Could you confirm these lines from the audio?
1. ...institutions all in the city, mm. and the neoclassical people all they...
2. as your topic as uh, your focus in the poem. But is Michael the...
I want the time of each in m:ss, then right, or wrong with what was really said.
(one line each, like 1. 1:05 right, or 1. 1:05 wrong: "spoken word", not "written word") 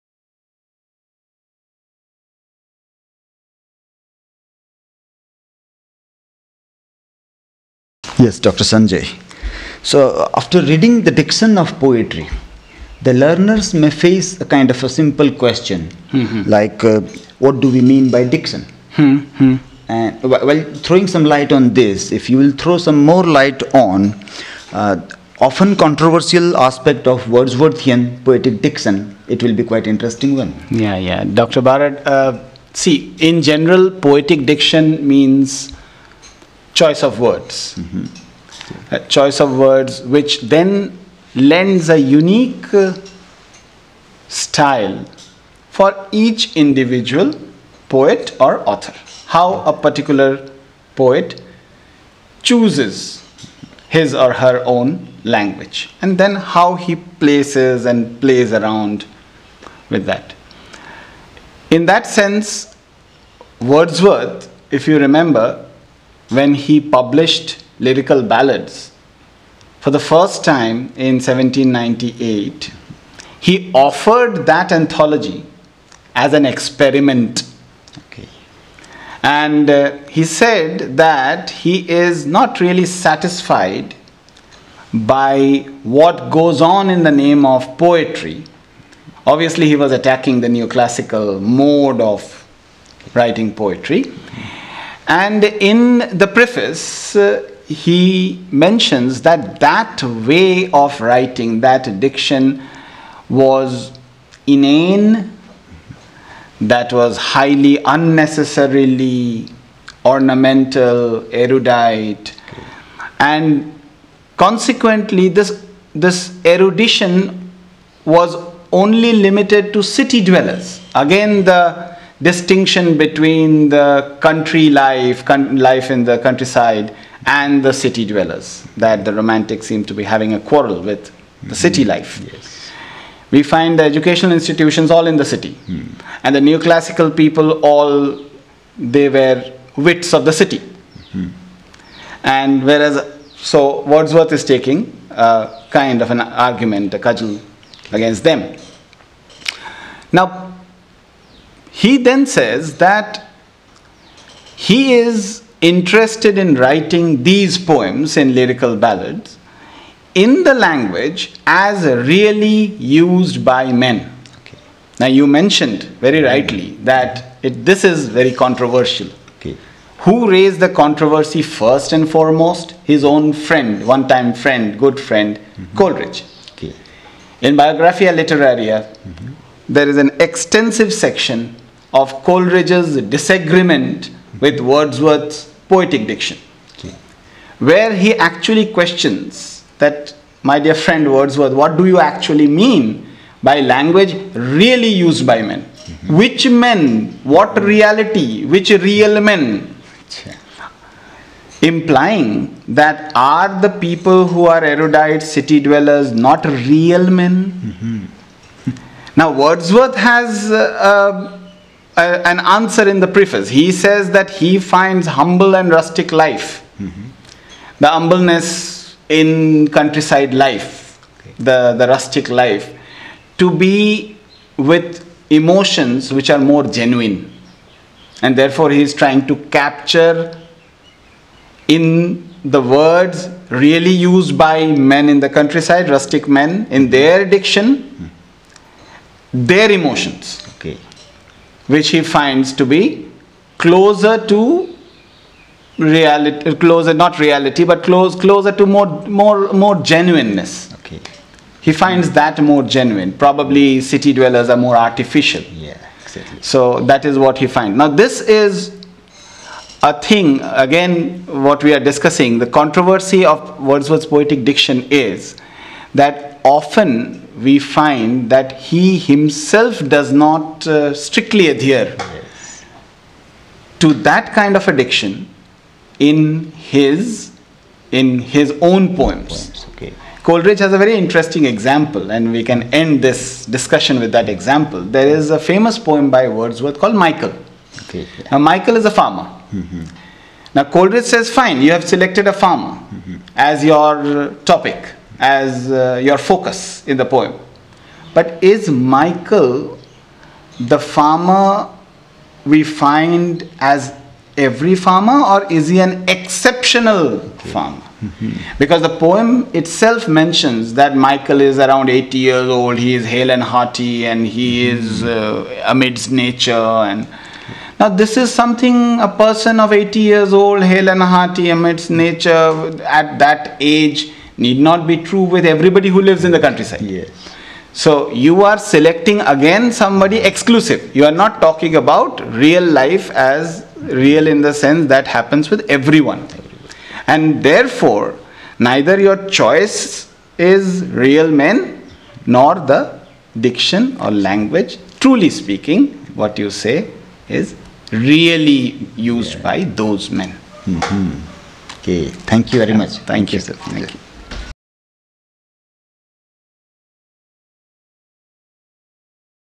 1. 2:14 right
2. 4:53 right.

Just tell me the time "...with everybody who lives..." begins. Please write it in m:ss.
5:25.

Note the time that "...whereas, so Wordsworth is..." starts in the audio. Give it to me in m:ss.
2:22.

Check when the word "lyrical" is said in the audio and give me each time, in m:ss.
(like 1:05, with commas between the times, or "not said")
1:07, 2:38.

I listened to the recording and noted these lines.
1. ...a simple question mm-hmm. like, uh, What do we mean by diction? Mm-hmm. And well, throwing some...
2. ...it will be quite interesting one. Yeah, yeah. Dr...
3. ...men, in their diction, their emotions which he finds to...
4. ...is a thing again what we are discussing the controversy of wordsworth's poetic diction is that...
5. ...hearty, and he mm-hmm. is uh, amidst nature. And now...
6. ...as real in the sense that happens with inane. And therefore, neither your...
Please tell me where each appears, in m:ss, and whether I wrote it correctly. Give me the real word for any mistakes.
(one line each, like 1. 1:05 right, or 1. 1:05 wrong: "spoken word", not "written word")
1. 0:14 right
2. 0:29 right
3. 3:56 right
4. 4:18 right
5. 5:13 right
6. 5:33 wrong: "everyone", not "inane".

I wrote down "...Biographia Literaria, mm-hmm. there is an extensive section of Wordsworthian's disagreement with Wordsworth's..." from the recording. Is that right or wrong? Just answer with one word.
wrong.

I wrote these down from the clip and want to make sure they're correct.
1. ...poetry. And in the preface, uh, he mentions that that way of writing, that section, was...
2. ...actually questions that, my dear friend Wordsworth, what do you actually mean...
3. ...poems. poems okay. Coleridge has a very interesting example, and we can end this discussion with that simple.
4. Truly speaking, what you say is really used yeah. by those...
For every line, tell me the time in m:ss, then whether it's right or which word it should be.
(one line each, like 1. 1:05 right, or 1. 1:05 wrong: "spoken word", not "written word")
1. 1:33 wrong: "diction", not "section"
2. 3:08 right
3. 4:38 wrong: "example", not "simple"
4. 5:44 right.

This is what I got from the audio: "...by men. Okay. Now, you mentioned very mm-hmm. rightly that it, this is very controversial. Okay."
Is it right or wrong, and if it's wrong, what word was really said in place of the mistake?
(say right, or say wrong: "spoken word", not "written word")
right.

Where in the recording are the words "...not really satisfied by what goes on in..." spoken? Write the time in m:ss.
1:22.